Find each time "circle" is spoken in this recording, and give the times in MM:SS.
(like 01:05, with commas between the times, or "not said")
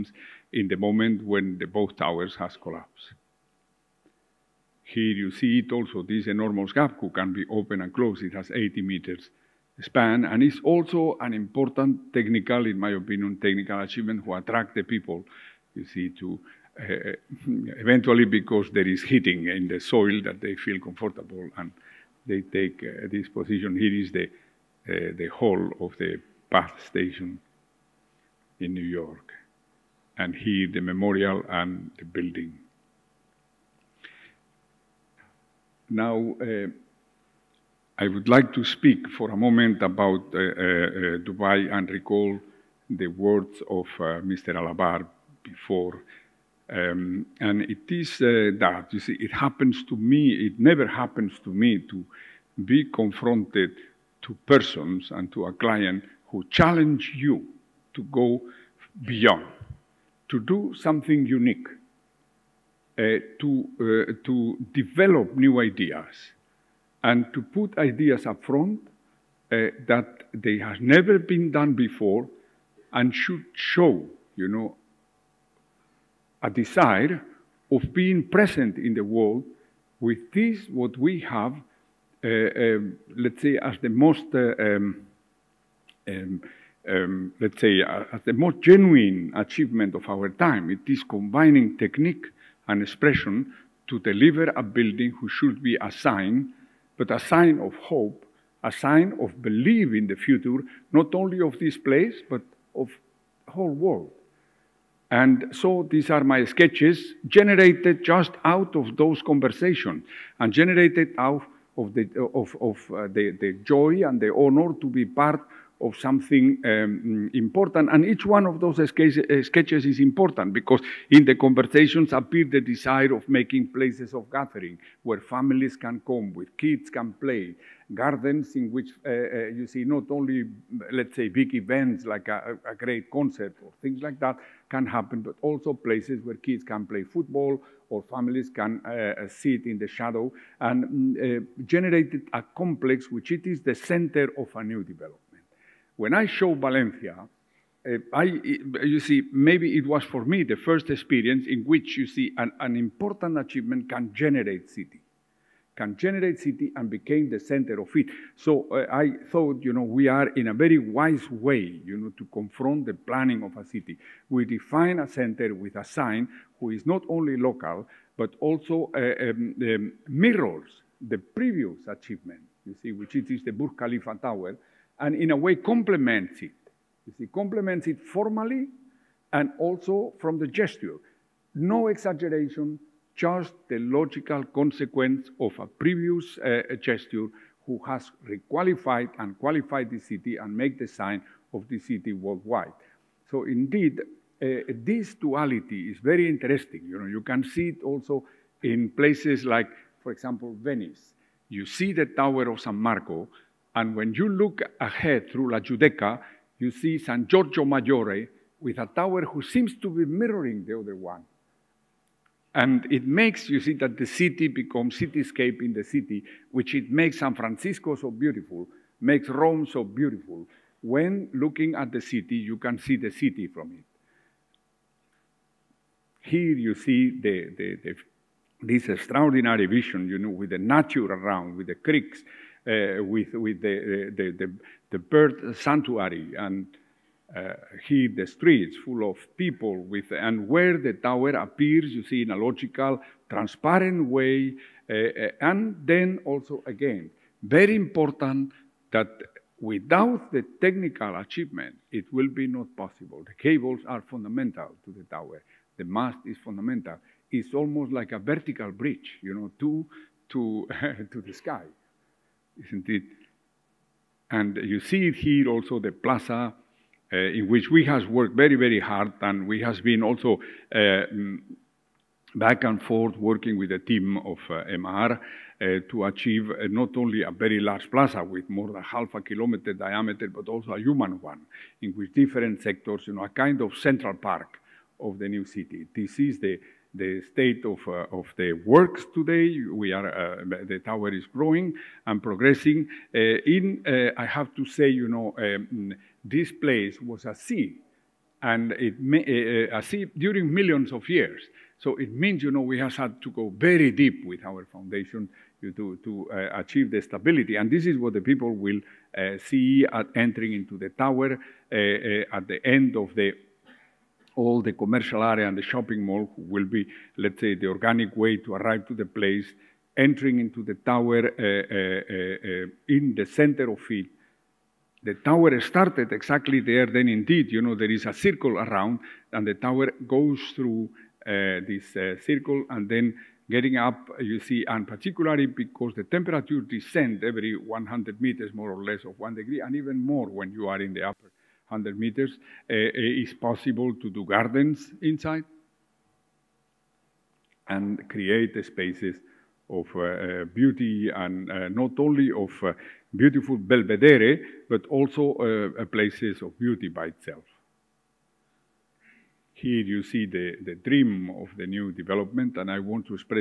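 05:28, 05:32.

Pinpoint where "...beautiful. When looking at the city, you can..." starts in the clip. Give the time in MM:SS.
03:39.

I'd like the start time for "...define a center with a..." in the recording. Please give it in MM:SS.
02:44.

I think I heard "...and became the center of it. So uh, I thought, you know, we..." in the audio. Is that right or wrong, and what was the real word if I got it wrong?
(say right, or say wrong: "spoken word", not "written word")
right.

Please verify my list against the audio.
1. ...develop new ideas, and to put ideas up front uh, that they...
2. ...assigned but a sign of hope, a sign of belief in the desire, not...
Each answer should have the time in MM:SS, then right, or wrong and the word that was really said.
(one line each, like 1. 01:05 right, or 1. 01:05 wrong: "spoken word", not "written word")
1. 01:04 right
2. 01:35 wrong: "future", not "desire".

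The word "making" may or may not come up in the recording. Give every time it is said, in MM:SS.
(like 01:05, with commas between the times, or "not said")
02:03.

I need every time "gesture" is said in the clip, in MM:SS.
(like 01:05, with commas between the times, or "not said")
03:00, 03:06.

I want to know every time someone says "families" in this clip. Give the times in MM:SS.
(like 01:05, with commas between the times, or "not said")
02:05, 02:18.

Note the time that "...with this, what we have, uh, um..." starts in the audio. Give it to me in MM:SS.
01:20.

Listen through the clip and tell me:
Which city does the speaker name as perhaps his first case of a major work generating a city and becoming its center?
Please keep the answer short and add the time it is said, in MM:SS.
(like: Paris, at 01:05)
Valencia, at 02:26.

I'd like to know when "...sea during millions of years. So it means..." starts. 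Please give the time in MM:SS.
04:59.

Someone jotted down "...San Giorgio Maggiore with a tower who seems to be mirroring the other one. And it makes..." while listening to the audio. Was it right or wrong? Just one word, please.
right.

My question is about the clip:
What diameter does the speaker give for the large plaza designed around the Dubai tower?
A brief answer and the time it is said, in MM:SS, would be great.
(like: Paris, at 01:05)
more than half a kilometer, at 04:38.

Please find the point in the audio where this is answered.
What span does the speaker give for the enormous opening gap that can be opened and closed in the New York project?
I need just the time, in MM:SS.
00:08.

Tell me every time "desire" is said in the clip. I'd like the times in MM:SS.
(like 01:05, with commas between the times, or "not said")
01:16, 02:02.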